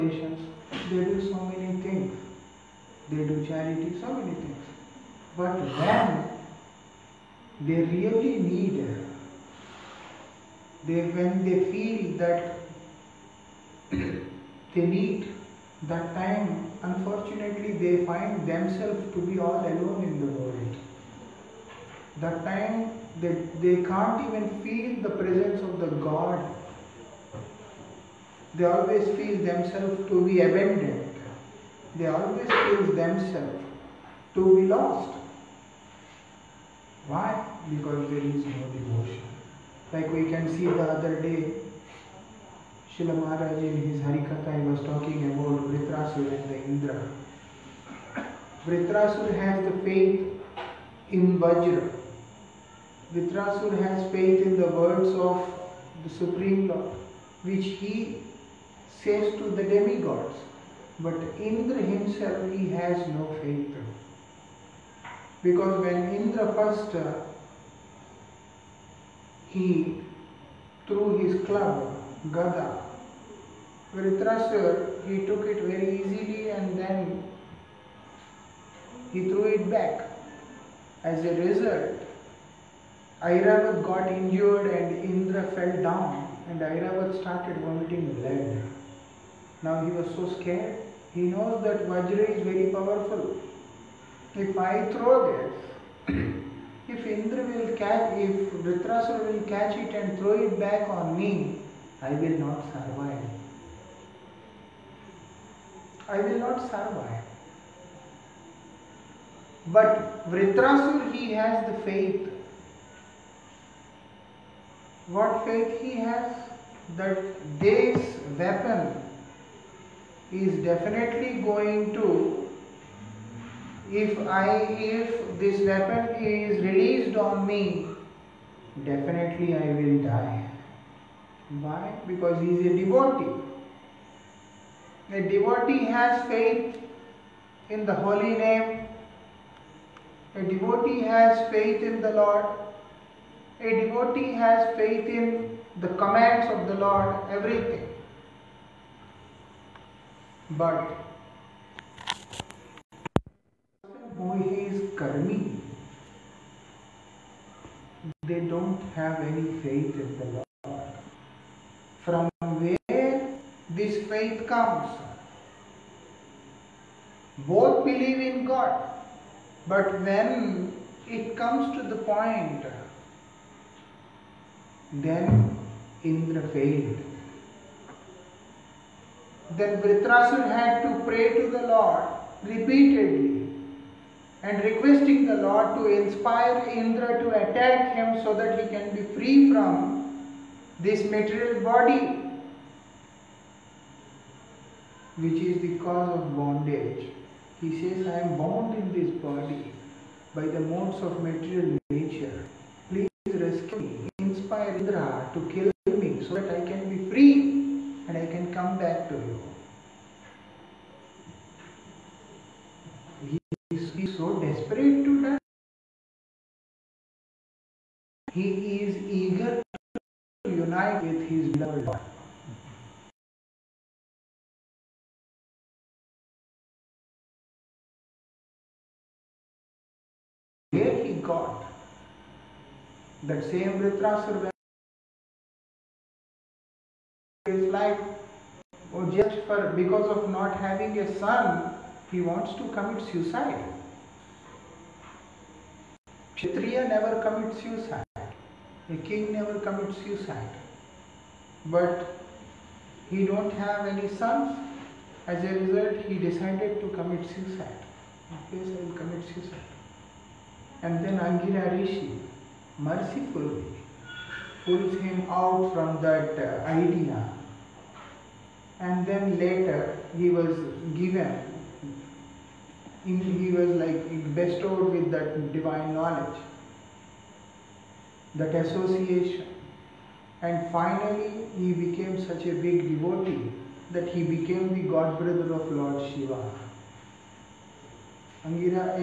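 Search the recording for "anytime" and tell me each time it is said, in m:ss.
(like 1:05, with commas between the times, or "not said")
not said.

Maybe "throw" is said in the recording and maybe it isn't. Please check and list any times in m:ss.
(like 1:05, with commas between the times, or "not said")
1:34, 1:40.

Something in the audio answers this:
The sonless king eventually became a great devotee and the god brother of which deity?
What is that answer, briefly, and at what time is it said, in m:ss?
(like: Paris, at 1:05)
Lord Shiva, at 4:45.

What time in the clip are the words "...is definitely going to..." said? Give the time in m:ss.
2:00.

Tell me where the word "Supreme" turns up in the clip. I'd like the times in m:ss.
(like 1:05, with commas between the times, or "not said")
0:56.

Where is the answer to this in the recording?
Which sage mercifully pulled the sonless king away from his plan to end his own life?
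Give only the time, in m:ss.
4:21.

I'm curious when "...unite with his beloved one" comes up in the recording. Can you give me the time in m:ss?
3:40.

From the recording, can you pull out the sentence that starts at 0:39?
Like we can see the other day, Srila Maharaj in his Harikatha he was talking about Vritrasur and the Indra.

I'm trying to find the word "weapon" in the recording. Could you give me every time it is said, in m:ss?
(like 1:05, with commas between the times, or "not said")
1:58, 2:05.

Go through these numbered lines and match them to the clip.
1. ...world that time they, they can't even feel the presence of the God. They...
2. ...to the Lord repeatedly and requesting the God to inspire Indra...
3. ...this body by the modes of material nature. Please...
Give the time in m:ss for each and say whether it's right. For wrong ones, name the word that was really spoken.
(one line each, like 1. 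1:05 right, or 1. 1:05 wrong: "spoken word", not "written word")
1. 0:20 right
2. 3:01 wrong: "Lord", not "God"
3. 3:18 right.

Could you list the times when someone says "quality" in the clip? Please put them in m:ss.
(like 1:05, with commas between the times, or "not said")
not said.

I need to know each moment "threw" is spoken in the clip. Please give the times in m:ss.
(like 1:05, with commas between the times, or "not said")
1:10, 1:19.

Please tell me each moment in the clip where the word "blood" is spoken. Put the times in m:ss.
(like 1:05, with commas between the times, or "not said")
1:28.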